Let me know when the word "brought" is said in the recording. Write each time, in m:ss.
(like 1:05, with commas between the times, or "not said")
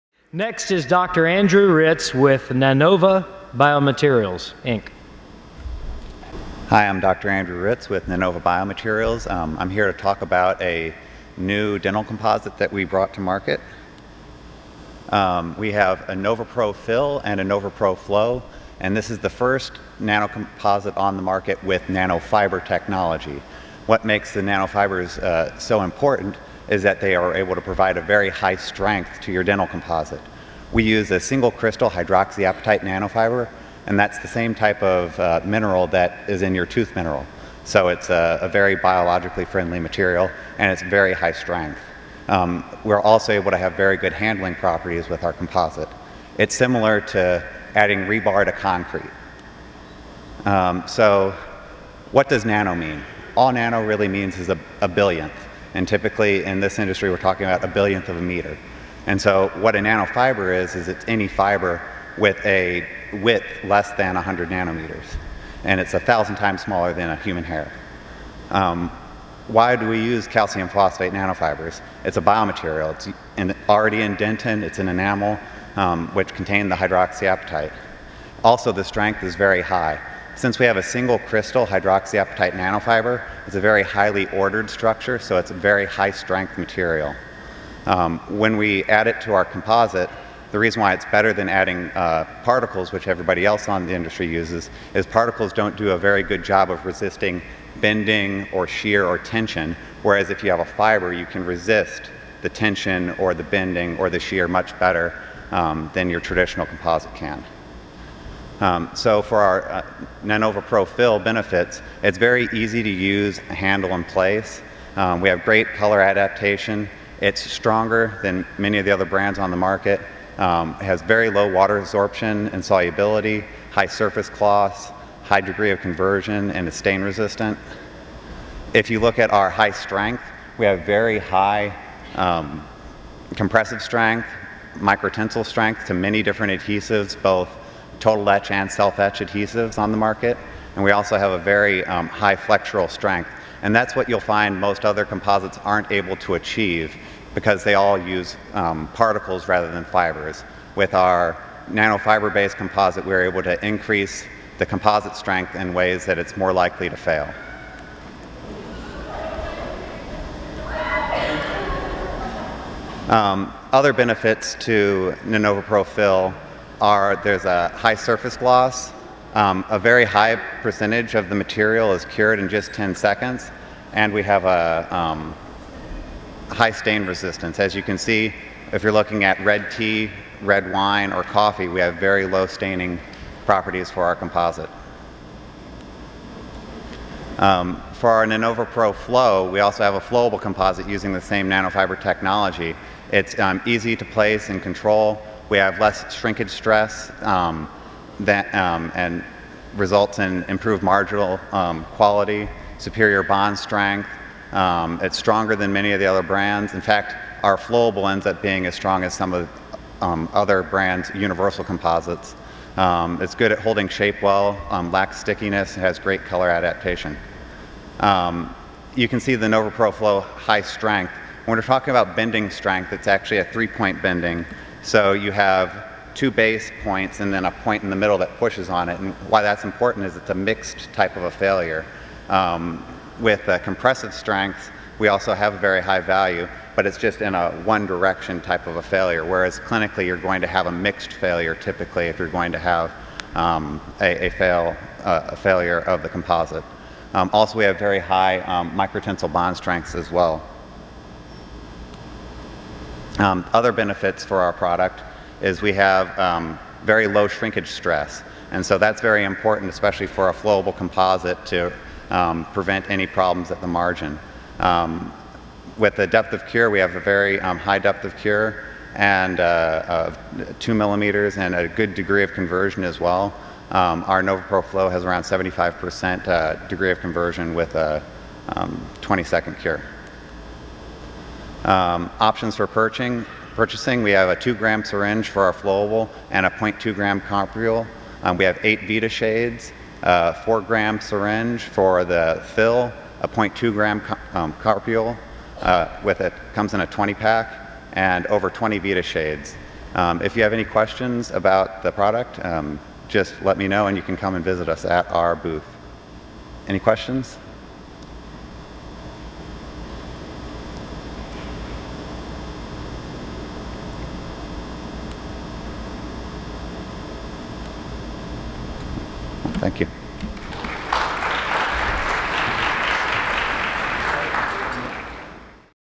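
0:12.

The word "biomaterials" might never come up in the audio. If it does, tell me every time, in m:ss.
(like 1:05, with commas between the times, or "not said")
0:03, 0:08, 1:12.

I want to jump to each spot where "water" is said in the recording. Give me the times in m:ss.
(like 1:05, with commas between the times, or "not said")
2:01.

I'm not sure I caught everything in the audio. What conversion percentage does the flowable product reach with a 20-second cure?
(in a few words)
75%.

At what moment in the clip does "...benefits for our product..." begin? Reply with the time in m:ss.
4:13.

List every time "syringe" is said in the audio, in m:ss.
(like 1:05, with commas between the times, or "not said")
4:44, 4:50.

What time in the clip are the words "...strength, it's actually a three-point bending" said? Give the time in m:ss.
3:42.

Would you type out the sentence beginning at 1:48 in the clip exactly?
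Um, so for our uh, Nanova Pro Fill benefits, it's very easy to use, handle in place.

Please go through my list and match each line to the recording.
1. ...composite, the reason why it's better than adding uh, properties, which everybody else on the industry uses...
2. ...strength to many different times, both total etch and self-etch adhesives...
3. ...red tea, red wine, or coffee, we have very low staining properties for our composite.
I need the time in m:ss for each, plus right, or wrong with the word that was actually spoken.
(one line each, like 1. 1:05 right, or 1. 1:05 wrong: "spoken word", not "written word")
1. 1:29 wrong: "particles", not "properties"
2. 2:15 wrong: "adhesives", not "times"
3. 2:59 right.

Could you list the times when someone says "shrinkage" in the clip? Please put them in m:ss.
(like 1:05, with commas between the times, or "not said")
3:16, 4:17.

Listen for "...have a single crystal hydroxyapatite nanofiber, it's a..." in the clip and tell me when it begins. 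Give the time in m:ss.
1:20.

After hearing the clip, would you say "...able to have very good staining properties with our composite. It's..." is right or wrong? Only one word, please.
wrong.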